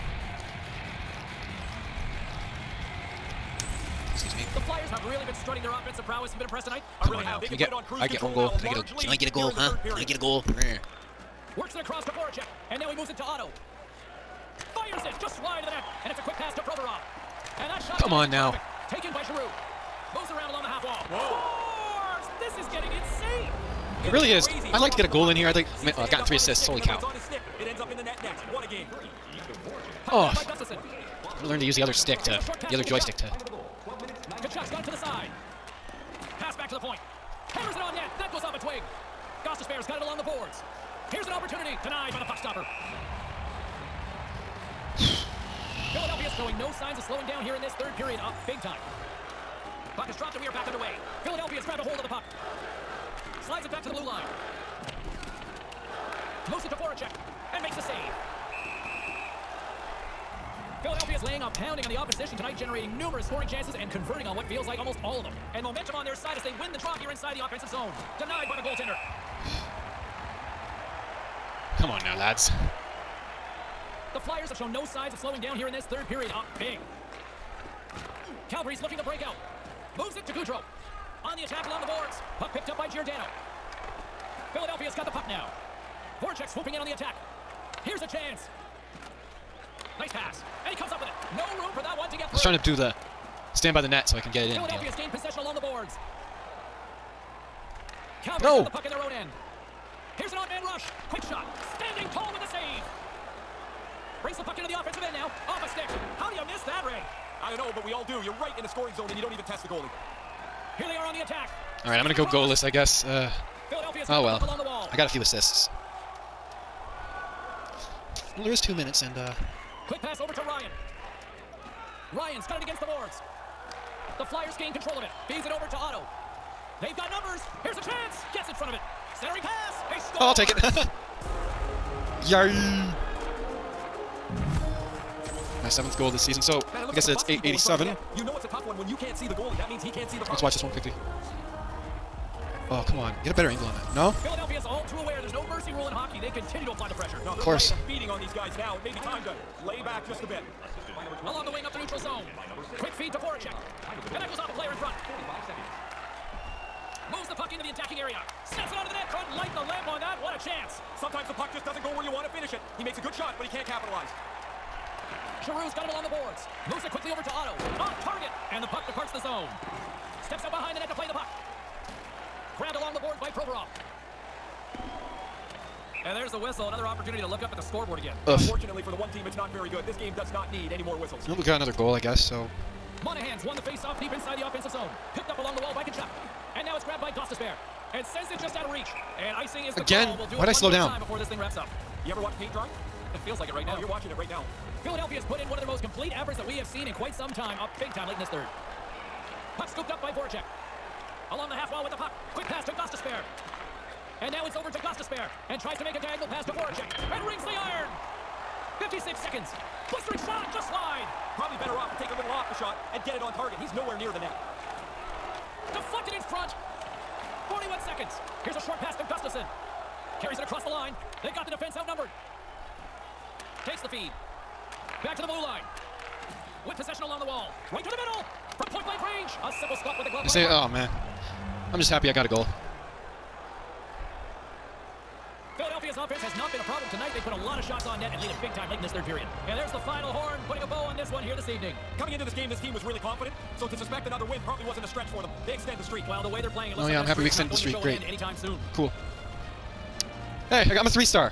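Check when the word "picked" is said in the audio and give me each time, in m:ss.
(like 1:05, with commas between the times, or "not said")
1:22, 3:05.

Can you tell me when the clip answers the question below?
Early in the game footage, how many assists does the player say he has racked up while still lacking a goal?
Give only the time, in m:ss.
0:26.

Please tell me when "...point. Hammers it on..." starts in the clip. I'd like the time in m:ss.
0:36.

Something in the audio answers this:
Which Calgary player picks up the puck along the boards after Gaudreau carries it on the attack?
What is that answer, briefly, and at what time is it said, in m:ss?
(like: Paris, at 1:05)
Giordano, at 1:22.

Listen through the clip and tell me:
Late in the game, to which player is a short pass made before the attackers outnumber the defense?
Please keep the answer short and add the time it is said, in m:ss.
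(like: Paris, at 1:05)
Gustafson, at 3:39.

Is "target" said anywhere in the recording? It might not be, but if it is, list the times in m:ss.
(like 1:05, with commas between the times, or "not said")
2:48, 3:33.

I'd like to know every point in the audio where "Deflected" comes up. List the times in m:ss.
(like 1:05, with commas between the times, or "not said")
3:35.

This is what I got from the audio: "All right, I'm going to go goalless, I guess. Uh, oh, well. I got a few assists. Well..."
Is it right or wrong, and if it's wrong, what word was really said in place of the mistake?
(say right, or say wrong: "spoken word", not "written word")
right.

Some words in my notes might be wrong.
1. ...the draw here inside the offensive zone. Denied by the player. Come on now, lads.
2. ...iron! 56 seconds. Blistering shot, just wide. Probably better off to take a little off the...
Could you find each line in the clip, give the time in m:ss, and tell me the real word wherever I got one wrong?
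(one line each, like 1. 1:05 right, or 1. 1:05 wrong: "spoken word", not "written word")
1. 1:06 wrong: "goaltender", not "player"
2. 3:27 right.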